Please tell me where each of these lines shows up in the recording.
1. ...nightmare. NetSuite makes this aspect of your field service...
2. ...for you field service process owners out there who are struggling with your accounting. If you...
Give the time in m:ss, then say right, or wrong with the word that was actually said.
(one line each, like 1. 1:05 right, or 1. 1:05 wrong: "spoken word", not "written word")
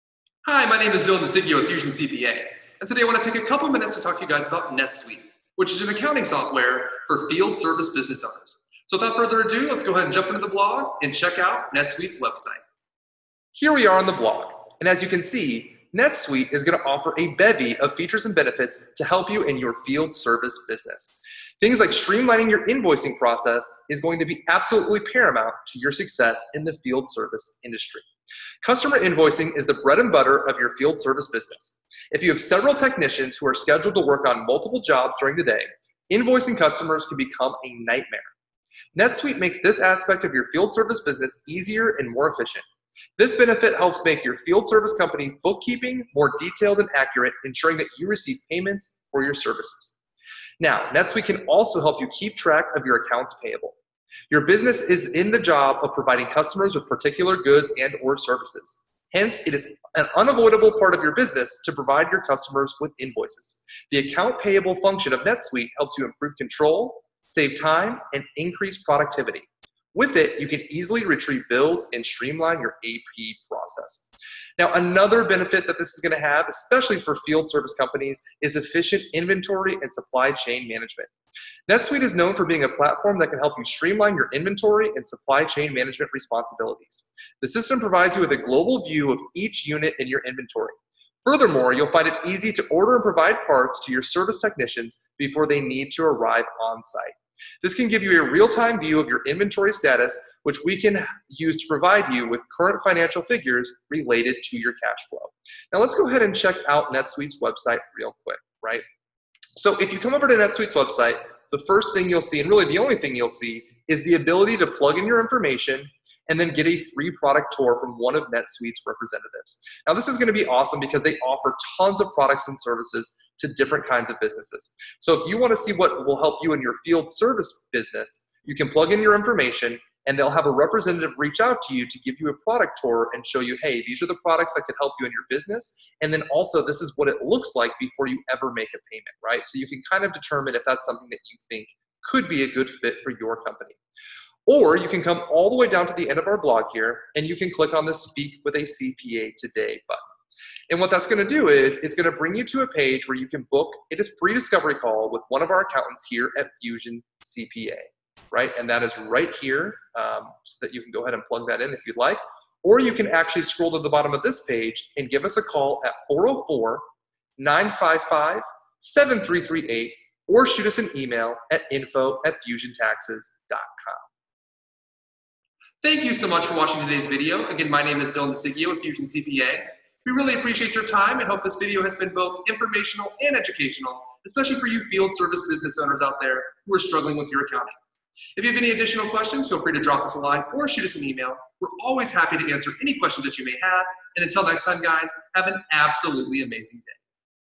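1. 0:37 right
2. 3:04 wrong: "business", not "process".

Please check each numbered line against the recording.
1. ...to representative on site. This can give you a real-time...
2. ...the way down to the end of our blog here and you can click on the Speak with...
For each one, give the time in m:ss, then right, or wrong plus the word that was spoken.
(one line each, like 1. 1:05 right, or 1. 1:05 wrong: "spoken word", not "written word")
1. 1:35 wrong: "arrive", not "representative"
2. 2:25 right.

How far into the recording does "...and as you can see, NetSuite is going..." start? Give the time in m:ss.
0:14.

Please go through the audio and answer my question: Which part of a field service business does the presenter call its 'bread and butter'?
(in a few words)
Customer invoicing.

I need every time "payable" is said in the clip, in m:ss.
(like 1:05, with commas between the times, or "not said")
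0:53, 1:04.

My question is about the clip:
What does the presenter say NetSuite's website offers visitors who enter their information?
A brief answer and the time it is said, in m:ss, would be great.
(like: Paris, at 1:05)
A free product tour, at 1:56.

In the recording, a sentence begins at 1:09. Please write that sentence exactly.
With it, you can easily retrieve bills and streamline your AP process.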